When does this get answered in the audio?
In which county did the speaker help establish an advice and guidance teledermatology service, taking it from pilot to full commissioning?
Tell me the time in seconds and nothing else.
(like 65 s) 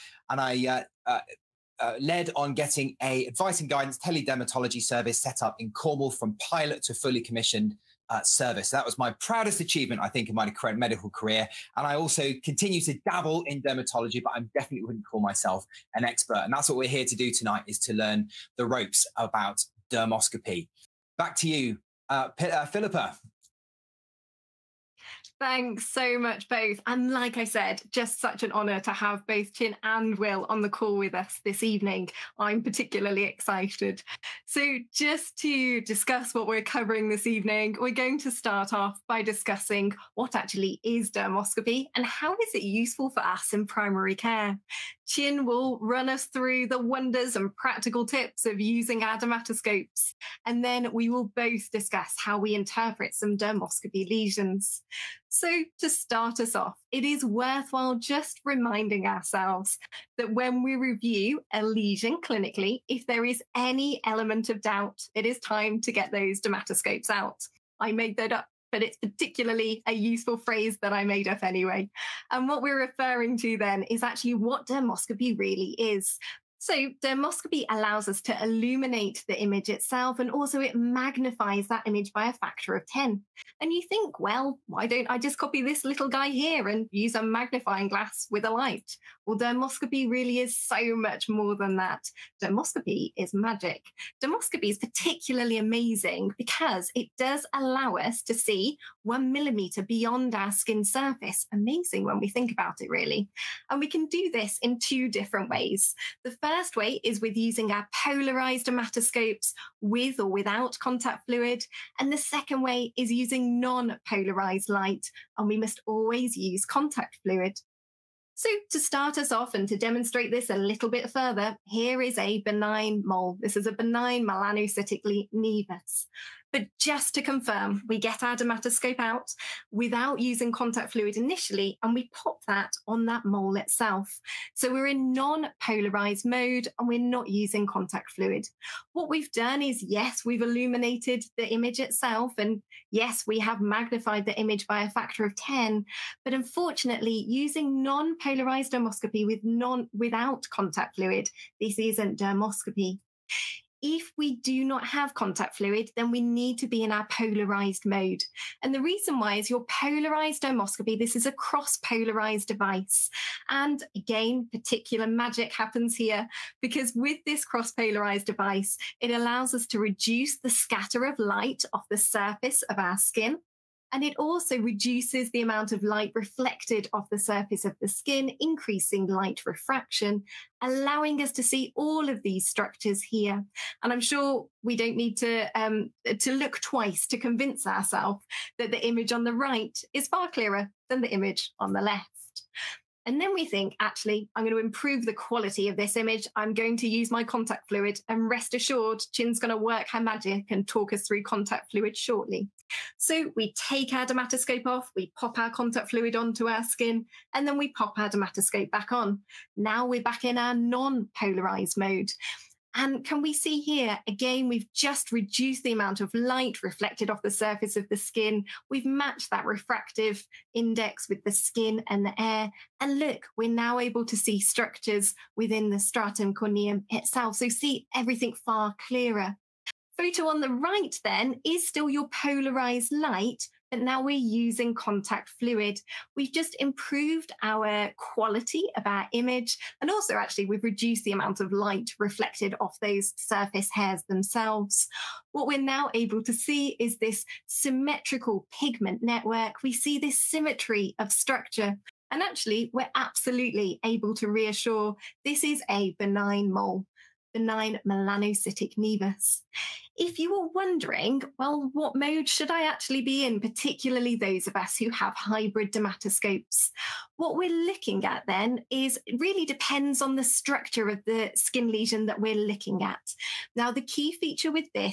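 5 s.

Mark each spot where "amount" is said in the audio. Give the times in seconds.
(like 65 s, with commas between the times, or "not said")
175 s, 215 s, 241 s.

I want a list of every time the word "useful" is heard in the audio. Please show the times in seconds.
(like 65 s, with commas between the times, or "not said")
42 s, 69 s.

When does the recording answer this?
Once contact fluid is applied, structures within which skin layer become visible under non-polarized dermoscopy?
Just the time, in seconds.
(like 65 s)
225 s.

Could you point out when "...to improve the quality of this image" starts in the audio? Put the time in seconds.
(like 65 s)
194 s.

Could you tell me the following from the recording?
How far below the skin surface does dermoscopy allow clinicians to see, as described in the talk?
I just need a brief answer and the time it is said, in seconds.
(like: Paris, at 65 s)
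1 millimeter, at 99 s.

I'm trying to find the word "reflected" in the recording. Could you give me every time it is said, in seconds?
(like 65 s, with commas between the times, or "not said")
176 s, 216 s, 241 s.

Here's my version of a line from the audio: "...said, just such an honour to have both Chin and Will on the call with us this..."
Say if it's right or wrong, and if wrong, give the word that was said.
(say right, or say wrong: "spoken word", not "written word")
right.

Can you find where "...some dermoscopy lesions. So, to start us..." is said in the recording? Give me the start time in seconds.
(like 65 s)
53 s.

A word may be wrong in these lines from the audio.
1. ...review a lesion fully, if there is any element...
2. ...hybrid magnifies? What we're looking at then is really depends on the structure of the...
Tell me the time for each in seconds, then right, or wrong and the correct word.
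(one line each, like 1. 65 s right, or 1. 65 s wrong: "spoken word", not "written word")
1. 60 s wrong: "clinically", not "fully"
2. 265 s wrong: "dermatoscopes", not "magnifies".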